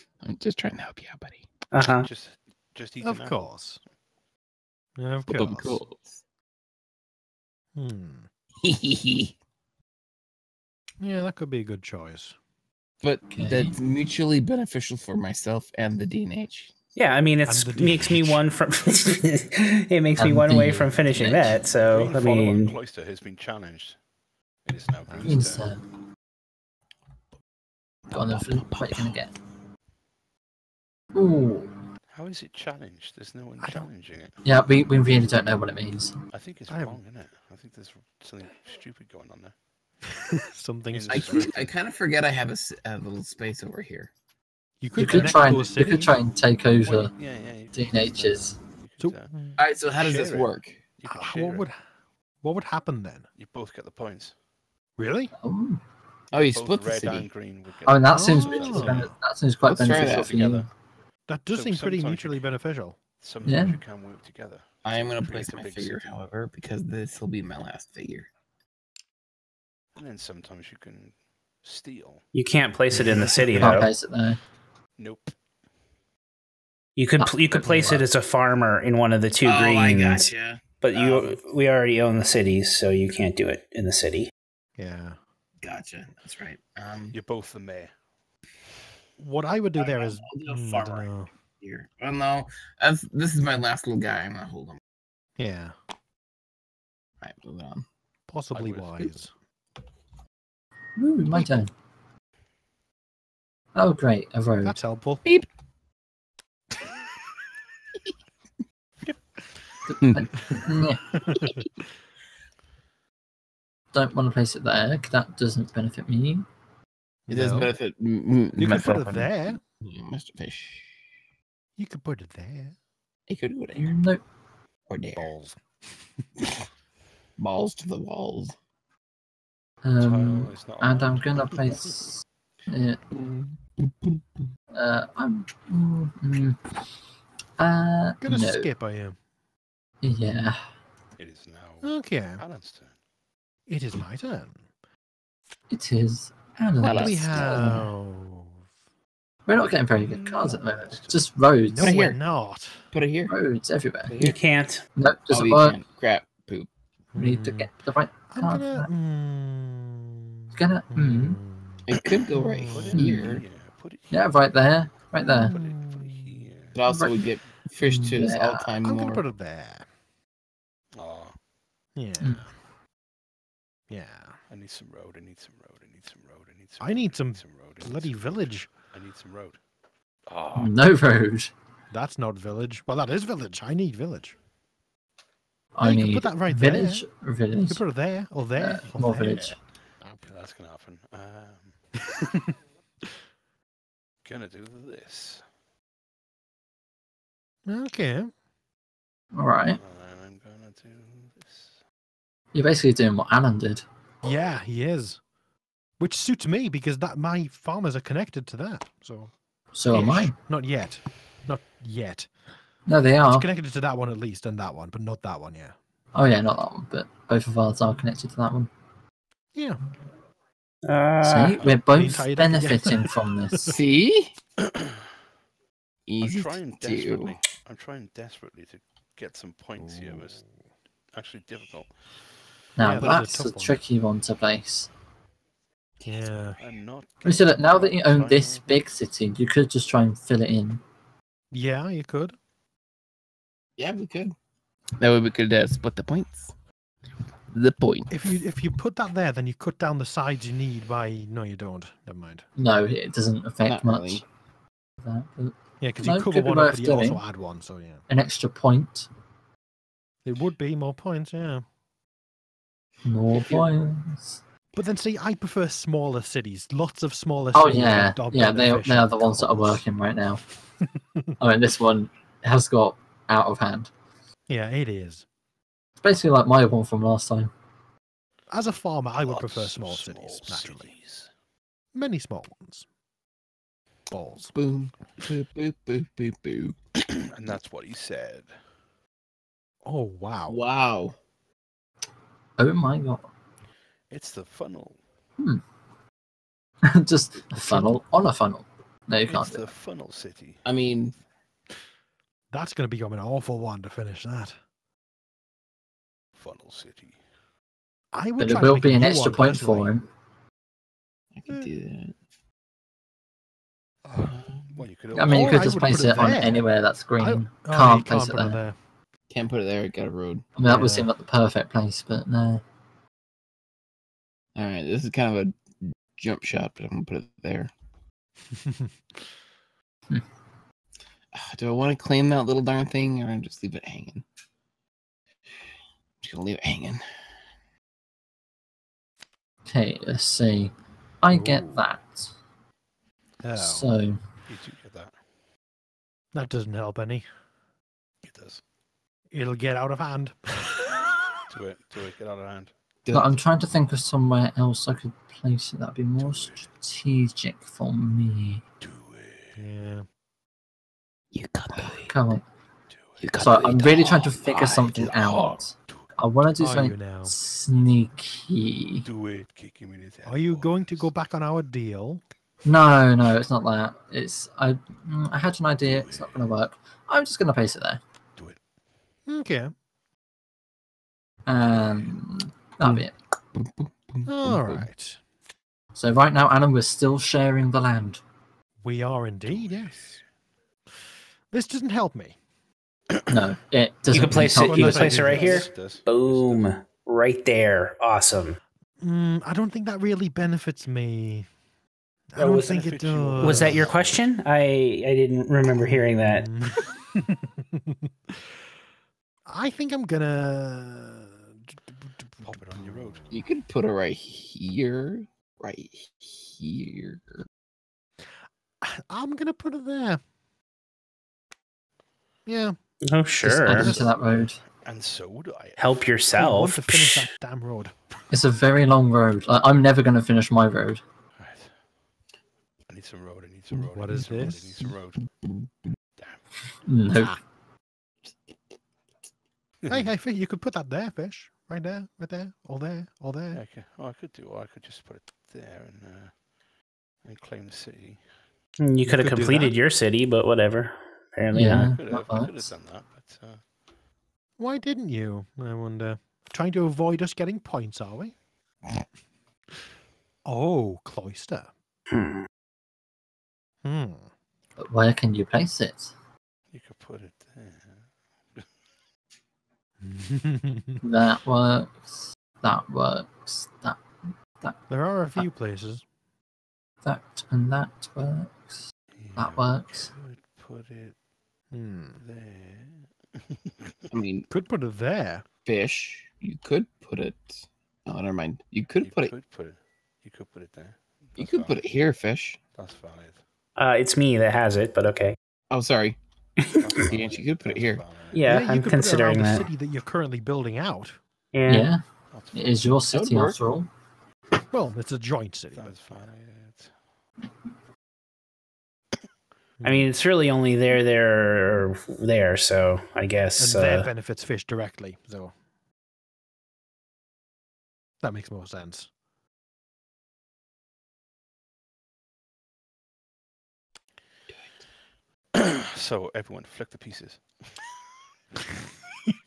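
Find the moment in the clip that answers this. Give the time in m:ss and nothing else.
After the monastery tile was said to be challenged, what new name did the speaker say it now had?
0:25.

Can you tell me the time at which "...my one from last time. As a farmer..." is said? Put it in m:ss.
4:36.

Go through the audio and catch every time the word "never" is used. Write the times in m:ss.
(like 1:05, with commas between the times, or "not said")
4:12, 7:09, 8:08.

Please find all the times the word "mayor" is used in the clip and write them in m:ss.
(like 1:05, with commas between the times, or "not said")
1:27.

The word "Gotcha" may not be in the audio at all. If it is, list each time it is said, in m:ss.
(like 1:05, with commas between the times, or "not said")
1:20, 1:25.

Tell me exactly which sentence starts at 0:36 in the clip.
I think it's I wrong, isn't it?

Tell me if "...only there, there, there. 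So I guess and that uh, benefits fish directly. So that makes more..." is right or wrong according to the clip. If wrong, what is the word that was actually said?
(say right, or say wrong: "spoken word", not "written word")
right.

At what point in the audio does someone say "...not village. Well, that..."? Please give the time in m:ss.
3:02.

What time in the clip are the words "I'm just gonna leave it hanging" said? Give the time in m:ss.
5:35.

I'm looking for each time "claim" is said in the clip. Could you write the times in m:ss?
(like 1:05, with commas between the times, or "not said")
5:32, 7:27.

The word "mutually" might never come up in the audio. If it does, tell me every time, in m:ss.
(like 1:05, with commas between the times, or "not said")
0:13, 1:02.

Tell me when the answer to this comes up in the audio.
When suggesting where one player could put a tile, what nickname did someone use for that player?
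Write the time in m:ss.
1:59.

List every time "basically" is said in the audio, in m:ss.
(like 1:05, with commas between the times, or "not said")
3:22, 4:36.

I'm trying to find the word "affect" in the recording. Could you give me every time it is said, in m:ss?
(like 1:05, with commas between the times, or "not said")
4:13.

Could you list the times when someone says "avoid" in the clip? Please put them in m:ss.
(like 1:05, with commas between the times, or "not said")
7:36.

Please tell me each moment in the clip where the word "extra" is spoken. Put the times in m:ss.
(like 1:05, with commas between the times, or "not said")
4:18, 5:09.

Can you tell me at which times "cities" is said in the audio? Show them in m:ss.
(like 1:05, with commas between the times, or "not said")
1:22, 4:26, 4:40.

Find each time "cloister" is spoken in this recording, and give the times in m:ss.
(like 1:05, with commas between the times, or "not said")
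0:22, 7:41.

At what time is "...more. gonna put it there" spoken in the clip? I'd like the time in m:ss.
2:48.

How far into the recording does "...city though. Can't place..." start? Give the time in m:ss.
1:13.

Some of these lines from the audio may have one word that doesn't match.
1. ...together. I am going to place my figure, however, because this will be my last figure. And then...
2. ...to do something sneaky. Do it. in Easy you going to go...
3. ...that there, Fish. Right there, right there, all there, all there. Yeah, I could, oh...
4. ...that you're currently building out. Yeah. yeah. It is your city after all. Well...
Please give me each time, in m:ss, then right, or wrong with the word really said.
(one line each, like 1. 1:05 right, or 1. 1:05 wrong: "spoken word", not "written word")
1. 1:04 right
2. 6:06 wrong: "Are", not "Easy"
3. 7:20 right
4. 8:19 right.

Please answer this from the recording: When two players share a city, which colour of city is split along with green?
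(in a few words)
red.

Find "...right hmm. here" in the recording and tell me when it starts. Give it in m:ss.
2:42.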